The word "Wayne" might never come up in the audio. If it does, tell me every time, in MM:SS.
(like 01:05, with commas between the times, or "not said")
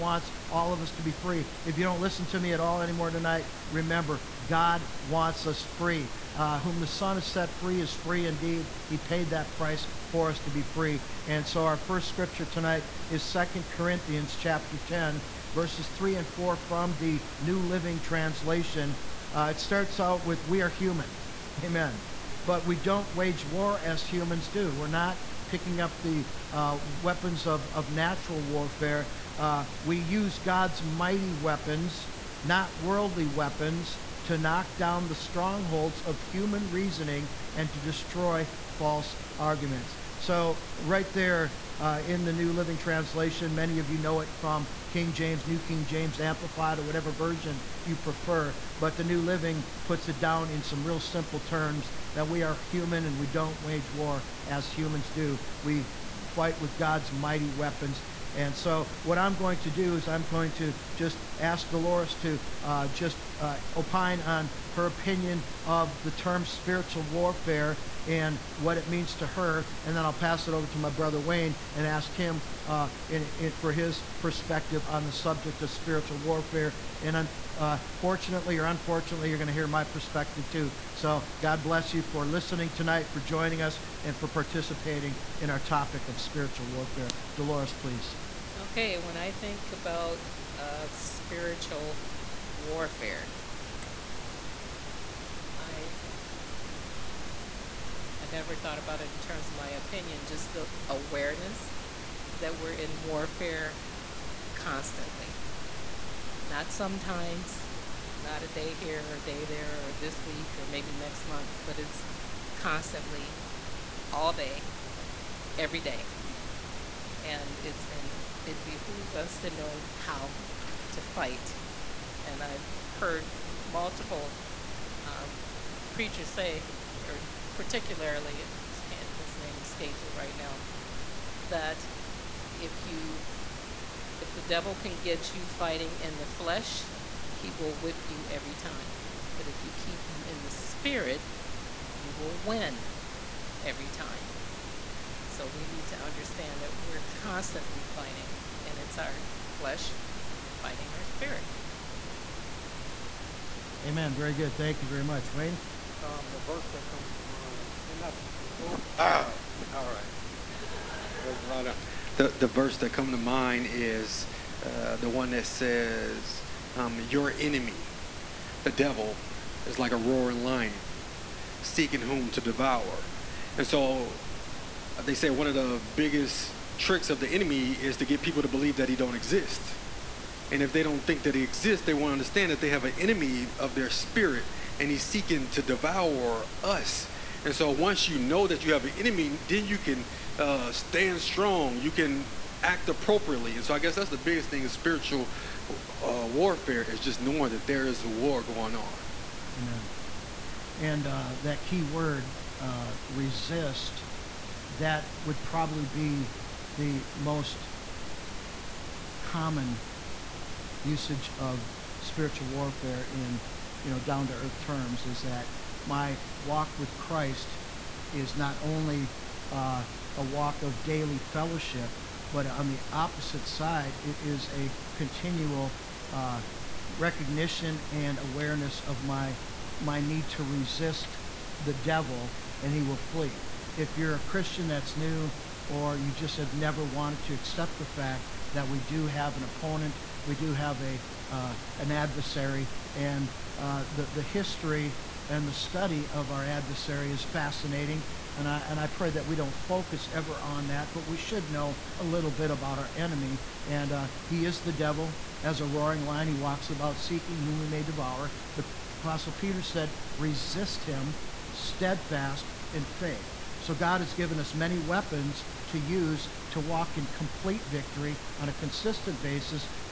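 01:11, 02:35.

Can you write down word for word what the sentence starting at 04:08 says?
And I, and I pray that we don't focus ever on that, but we should know a little bit about our enemy.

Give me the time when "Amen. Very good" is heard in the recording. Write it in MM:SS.
02:33.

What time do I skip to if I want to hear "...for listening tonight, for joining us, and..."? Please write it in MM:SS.
01:22.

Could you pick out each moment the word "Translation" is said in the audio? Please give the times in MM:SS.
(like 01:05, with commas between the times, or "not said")
00:18, 00:42.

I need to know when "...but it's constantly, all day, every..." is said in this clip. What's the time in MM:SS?
01:51.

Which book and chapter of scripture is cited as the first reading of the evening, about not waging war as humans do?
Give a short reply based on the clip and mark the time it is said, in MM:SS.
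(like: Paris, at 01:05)
Second Corinthians chapter 10, at 00:13.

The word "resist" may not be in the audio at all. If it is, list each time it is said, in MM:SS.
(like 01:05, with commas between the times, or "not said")
03:23, 03:50, 04:20.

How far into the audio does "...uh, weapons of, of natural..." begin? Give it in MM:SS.
00:26.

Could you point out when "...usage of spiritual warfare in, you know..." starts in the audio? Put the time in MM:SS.
03:30.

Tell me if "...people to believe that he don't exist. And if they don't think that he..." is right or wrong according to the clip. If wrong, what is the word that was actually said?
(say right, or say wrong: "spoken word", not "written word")
right.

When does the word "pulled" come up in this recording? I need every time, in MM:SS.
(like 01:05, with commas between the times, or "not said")
not said.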